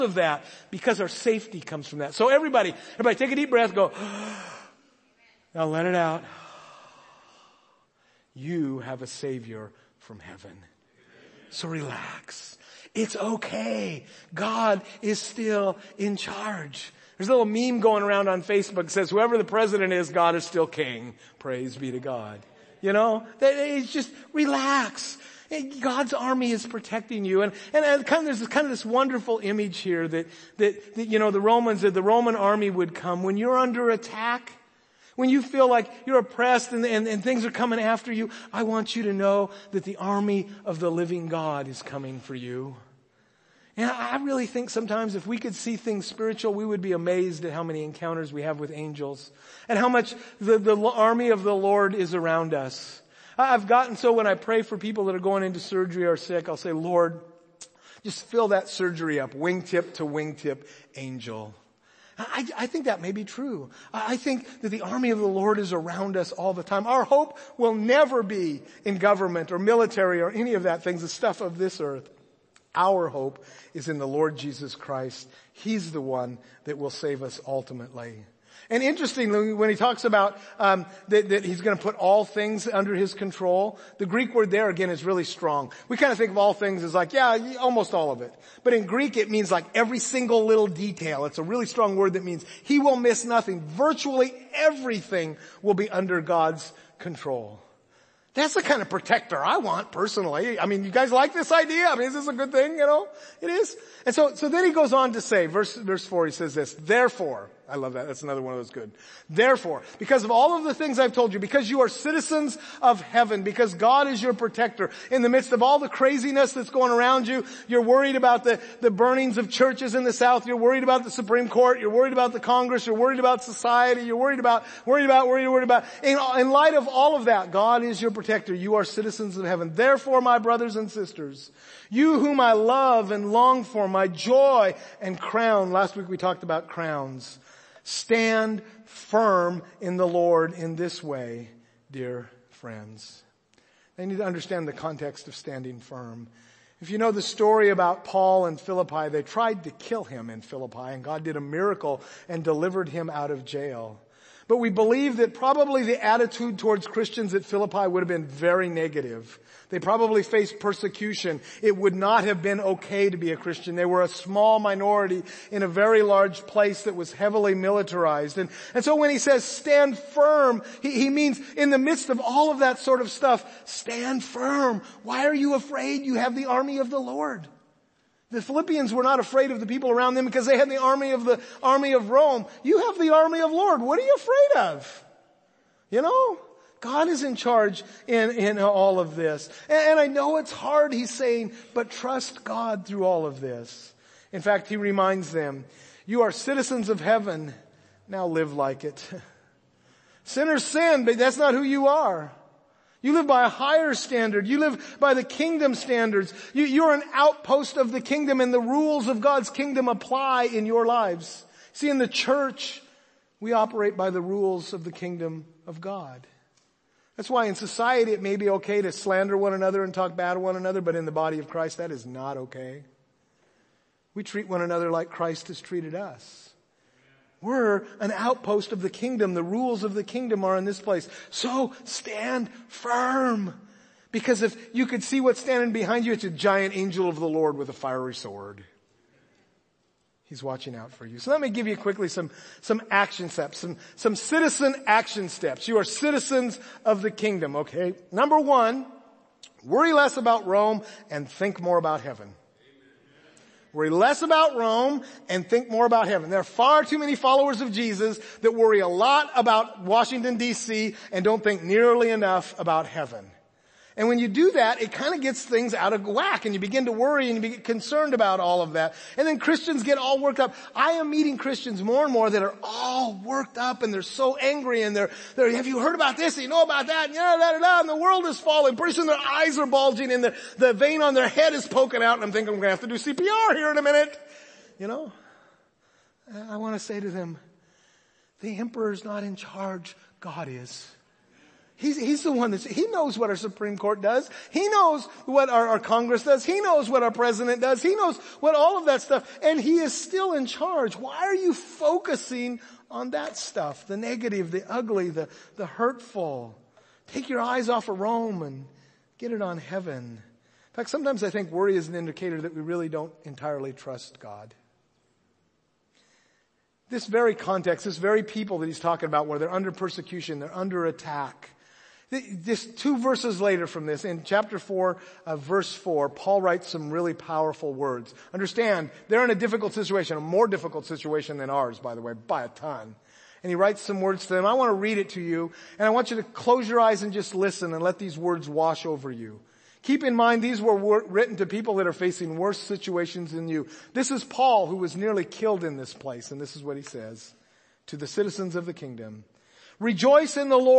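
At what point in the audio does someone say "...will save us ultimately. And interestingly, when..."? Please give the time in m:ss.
1:16.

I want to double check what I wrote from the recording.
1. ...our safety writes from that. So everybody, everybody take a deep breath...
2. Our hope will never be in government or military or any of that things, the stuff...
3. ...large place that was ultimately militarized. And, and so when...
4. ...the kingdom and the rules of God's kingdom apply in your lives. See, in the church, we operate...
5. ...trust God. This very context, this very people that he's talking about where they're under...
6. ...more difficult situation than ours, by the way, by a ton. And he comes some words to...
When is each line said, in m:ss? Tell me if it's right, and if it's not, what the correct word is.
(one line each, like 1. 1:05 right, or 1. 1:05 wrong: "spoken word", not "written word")
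1. 0:00 wrong: "comes", not "writes"
2. 1:06 right
3. 2:46 wrong: "heavily", not "ultimately"
4. 3:27 right
5. 5:13 right
6. 5:30 wrong: "writes", not "comes".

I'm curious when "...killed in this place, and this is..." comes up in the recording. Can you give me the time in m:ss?
5:45.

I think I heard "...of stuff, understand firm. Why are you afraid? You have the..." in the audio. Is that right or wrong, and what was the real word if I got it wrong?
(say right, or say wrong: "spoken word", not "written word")
wrong: "stand", not "understand".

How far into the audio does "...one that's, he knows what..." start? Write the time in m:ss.
4:52.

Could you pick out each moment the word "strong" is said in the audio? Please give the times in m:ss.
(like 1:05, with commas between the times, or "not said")
1:25, 1:31.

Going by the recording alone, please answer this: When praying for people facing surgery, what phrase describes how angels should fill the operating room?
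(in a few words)
Wingtip to wingtip.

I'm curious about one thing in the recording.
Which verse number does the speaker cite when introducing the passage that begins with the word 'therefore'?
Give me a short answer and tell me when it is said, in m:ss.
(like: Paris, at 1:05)
Four, at 1:45.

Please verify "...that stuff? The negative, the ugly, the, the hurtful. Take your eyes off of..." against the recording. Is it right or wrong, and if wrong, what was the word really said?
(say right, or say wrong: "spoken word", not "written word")
right.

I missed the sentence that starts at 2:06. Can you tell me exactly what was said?
In, in light of all of that, God is your protector.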